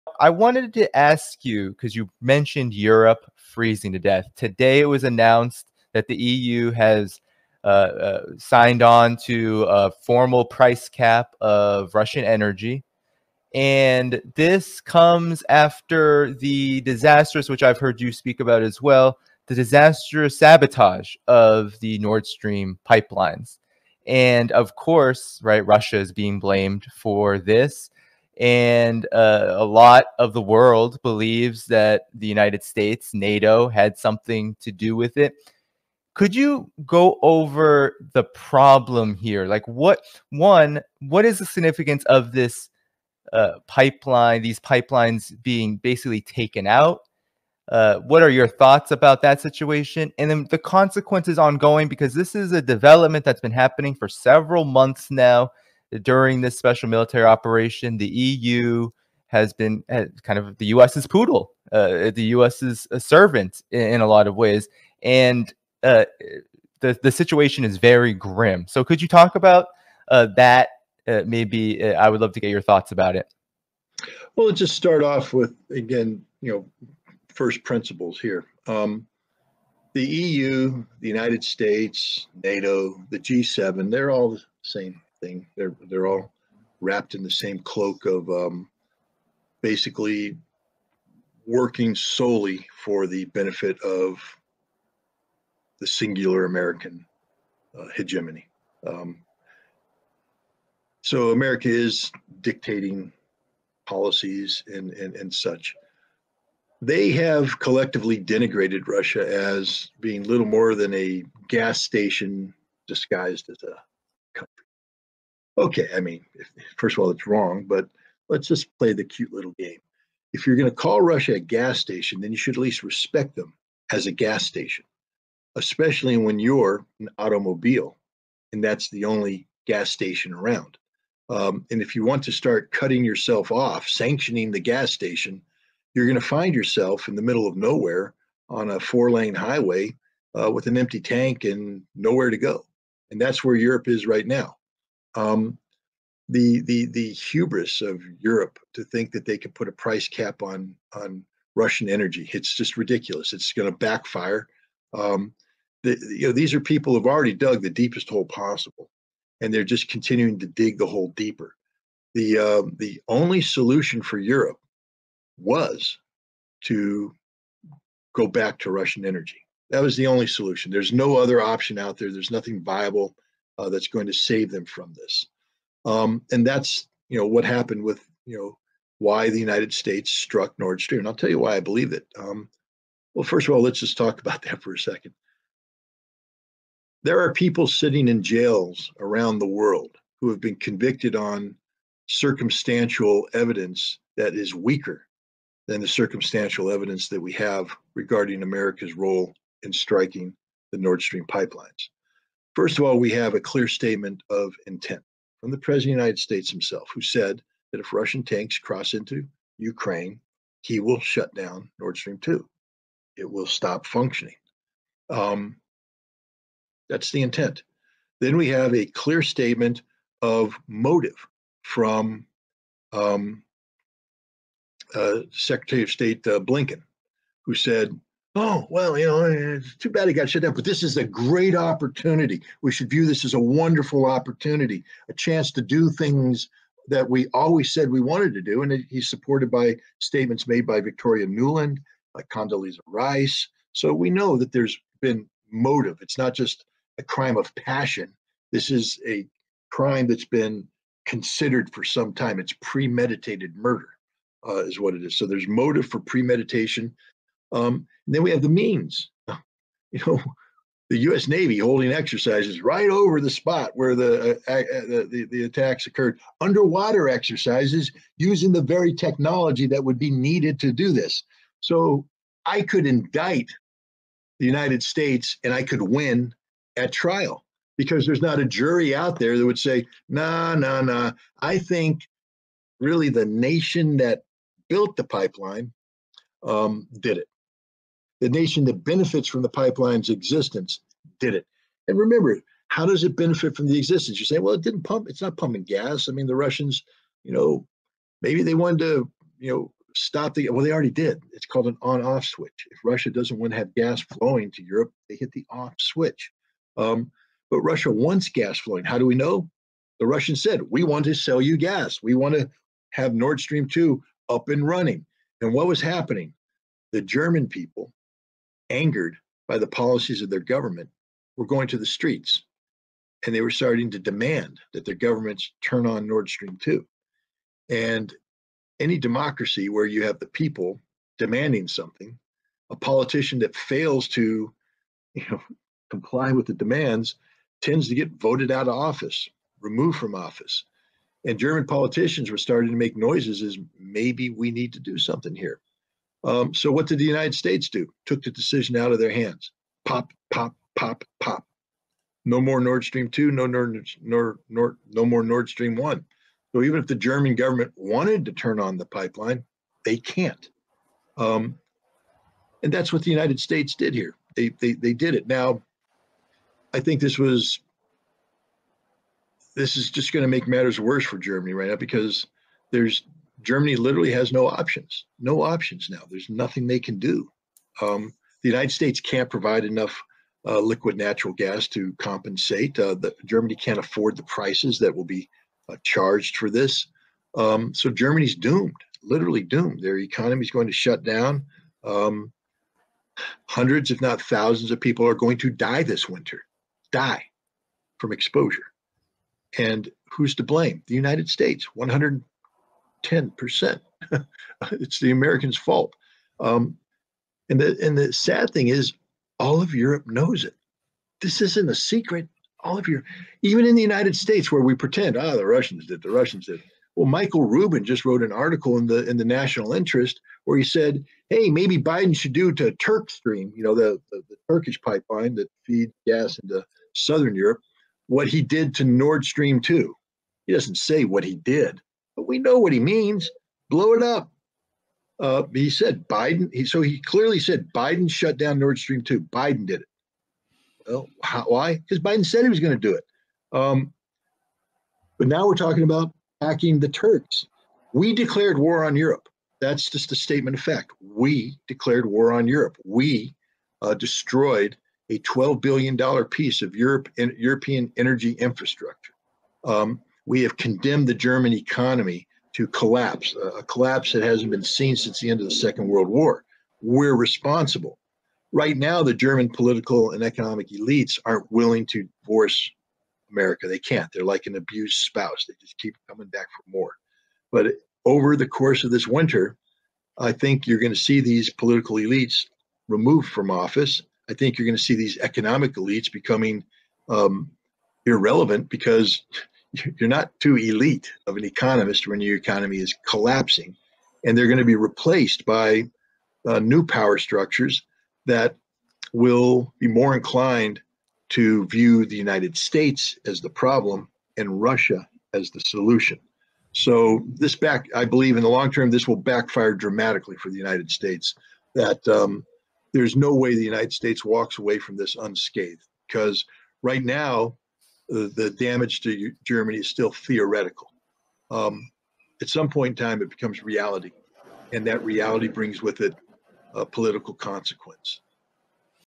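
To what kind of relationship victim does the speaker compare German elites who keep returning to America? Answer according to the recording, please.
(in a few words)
An abused spouse.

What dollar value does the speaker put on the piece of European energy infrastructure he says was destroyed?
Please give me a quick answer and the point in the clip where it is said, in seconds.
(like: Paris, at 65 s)
$12 billion, at 455 s.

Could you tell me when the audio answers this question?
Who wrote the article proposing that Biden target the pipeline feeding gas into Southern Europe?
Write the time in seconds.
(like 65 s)
417 s.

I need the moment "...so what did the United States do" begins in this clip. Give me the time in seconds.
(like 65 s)
346 s.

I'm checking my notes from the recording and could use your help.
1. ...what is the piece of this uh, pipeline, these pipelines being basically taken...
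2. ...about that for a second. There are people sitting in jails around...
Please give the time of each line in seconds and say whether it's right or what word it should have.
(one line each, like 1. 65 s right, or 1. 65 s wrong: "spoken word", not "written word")
1. 41 s wrong: "significance", not "piece"
2. 184 s right.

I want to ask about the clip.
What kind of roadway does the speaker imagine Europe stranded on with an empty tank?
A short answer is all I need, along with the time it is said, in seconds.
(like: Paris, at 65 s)
A four lane highway, at 138 s.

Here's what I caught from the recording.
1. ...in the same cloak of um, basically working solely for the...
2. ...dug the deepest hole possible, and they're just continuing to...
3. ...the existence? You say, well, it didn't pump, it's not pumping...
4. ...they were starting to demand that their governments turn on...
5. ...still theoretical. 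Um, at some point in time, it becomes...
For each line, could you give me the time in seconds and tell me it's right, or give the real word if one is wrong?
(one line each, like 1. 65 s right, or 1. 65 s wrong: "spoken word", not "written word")
1. 87 s right
2. 157 s right
3. 293 s right
4. 323 s right
5. 519 s right.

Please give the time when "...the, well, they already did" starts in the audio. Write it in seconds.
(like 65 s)
300 s.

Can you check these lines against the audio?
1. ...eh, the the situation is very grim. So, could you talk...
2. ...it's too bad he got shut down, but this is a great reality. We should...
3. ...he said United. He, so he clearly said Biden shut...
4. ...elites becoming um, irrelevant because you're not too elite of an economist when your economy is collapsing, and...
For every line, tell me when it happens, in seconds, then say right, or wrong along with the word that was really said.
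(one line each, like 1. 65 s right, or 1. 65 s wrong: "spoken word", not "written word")
1. 66 s right
2. 229 s wrong: "opportunity", not "reality"
3. 435 s wrong: "Biden", not "United"
4. 485 s right.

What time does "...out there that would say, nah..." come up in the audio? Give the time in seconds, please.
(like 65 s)
278 s.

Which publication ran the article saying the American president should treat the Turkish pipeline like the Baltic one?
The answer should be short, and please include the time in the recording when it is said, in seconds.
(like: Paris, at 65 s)
The National Interest, at 419 s.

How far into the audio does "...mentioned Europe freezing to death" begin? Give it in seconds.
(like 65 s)
2 s.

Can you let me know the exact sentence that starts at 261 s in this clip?
Navy holding exercises right over the spot where the, uh, uh, the, the attacks occurred.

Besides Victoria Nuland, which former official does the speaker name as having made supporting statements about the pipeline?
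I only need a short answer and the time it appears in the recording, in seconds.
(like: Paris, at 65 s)
Condoleezza Rice, at 242 s.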